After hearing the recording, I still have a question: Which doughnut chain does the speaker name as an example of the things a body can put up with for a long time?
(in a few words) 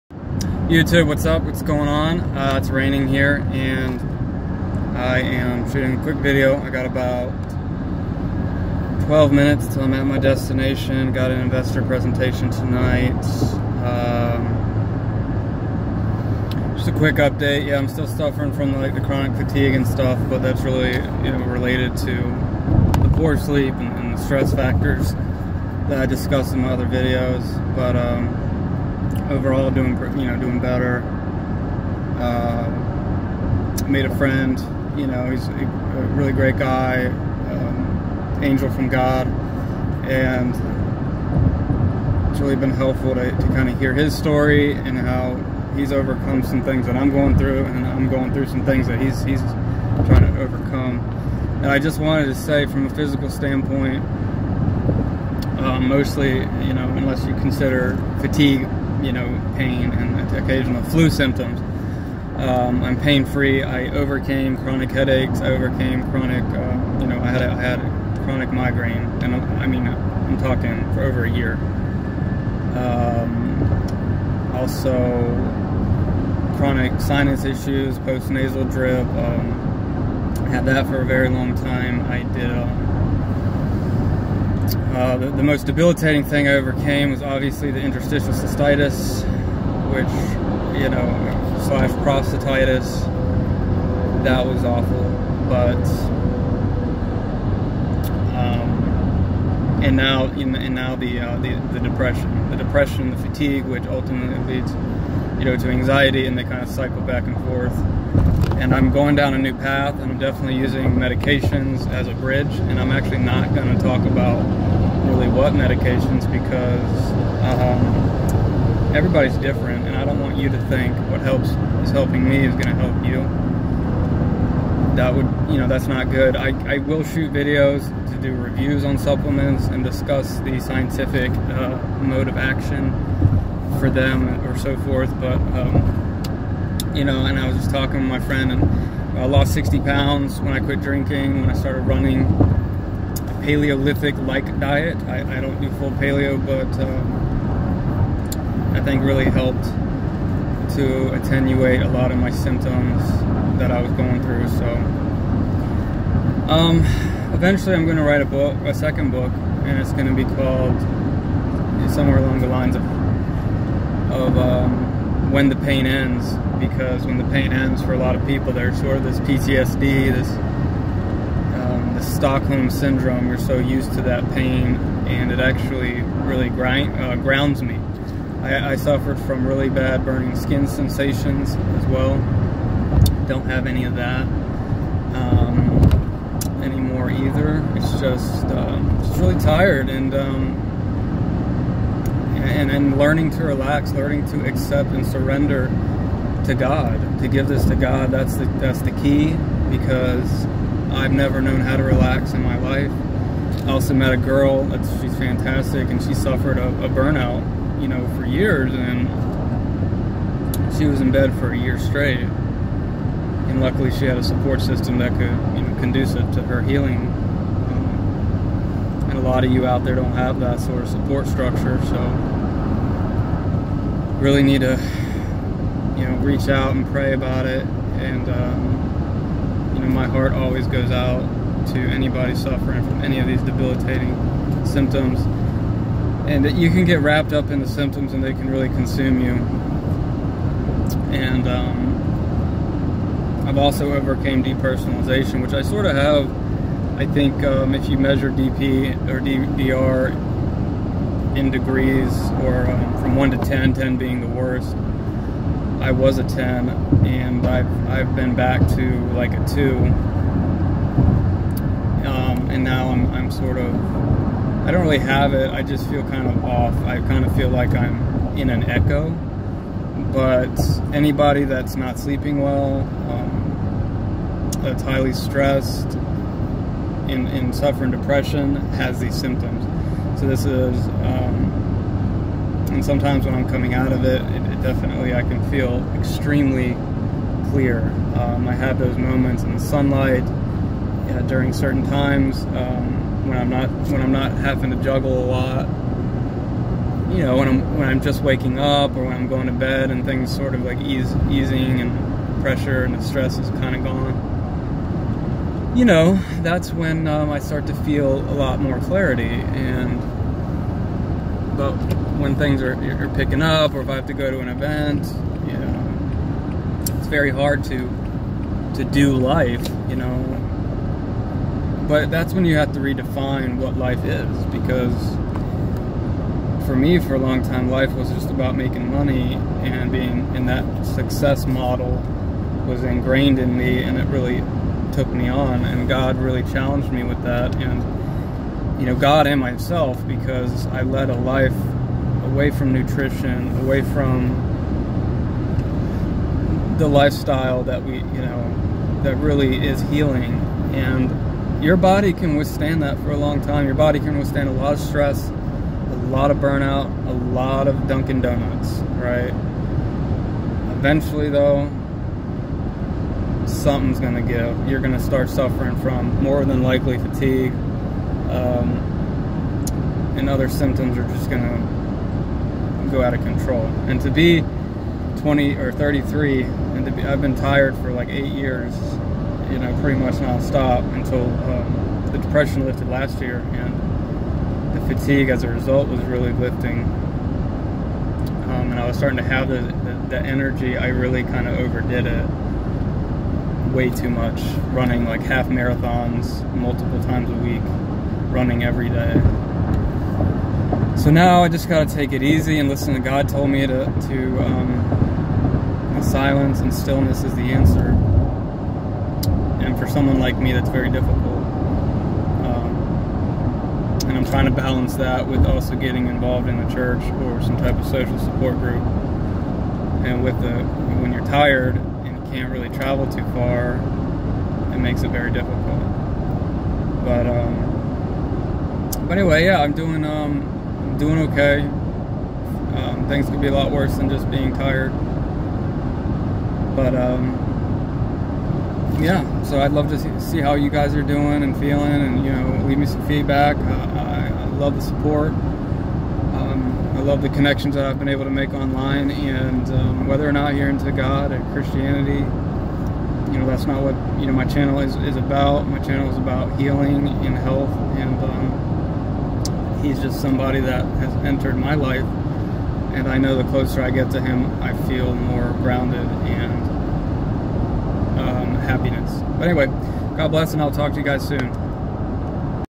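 Dunkin' Donuts.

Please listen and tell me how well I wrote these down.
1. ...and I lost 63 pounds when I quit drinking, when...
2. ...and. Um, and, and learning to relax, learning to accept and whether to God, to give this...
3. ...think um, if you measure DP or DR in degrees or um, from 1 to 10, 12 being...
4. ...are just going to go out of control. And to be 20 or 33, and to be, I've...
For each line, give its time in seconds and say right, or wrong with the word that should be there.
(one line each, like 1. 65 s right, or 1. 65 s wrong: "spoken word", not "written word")
1. 138 s wrong: "60", not "63"
2. 189 s wrong: "surrender", not "whether"
3. 247 s wrong: "10", not "12"
4. 370 s right.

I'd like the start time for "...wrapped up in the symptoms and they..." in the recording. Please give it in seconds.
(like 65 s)
237 s.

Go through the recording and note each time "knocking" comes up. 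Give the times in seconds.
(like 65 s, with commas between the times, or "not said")
not said.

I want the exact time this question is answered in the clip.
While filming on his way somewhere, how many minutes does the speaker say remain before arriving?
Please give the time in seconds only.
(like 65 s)
9 s.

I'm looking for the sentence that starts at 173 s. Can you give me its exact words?
You're so used to that pain, and it actually really grind, uh, grounds me.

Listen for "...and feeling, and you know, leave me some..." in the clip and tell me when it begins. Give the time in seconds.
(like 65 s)
441 s.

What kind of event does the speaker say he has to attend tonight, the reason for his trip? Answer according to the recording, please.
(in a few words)
Investor presentation.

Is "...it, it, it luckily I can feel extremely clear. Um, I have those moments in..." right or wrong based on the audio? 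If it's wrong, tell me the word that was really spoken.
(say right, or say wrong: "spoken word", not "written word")
wrong: "definitely", not "luckily".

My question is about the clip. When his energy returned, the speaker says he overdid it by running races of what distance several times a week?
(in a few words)
Half marathons.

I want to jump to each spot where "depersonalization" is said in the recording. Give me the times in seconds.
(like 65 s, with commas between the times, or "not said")
244 s.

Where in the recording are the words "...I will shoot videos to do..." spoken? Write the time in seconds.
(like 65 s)
126 s.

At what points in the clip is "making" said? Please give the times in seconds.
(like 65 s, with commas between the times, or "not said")
328 s.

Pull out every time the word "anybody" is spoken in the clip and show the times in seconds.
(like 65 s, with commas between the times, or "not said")
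231 s, 270 s.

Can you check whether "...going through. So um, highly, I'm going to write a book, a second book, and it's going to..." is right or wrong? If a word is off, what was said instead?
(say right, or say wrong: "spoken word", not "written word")
wrong: "eventually", not "highly".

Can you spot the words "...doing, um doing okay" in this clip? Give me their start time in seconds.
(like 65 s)
429 s.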